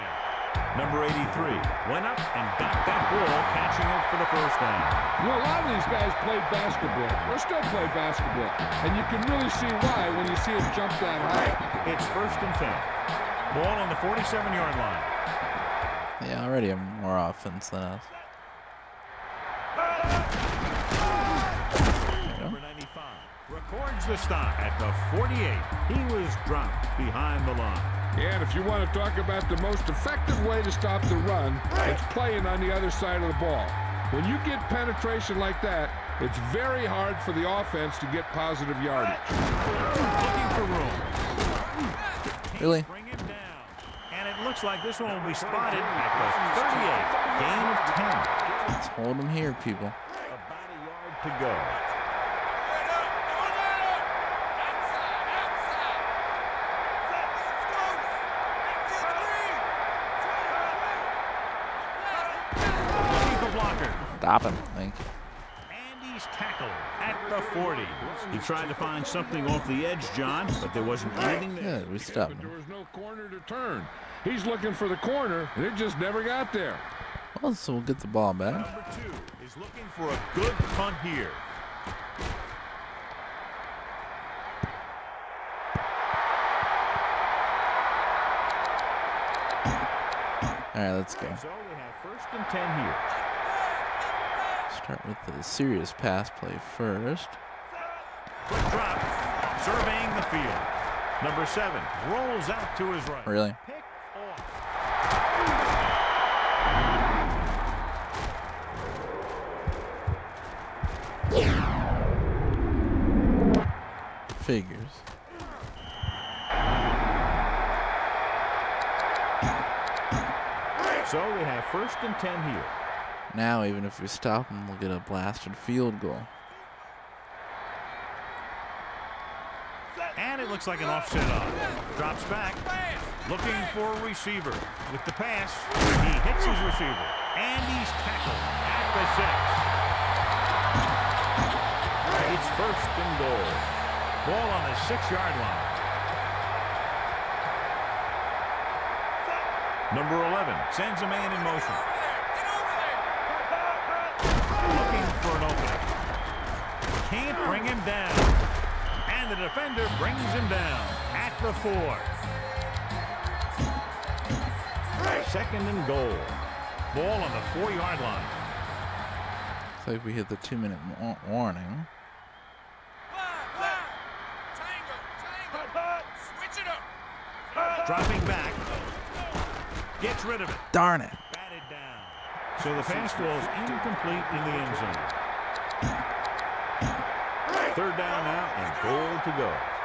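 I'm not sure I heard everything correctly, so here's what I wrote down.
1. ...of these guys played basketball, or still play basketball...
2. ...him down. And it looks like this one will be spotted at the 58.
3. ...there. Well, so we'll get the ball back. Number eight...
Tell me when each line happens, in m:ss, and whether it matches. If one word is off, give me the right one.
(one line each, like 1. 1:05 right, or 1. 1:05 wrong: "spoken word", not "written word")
1. 0:05 right
2. 0:43 wrong: "38", not "58"
3. 1:16 wrong: "two", not "eight".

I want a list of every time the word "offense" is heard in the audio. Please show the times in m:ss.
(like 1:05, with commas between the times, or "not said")
0:17, 0:37.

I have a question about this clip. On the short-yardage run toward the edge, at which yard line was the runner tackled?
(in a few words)
40.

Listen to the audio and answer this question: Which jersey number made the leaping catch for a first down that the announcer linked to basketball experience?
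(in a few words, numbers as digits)
83.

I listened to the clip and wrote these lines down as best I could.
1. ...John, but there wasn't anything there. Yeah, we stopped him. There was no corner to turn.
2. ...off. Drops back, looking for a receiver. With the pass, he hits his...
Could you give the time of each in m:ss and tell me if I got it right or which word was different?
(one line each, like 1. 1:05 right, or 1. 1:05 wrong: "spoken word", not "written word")
1. 1:10 right
2. 2:11 right.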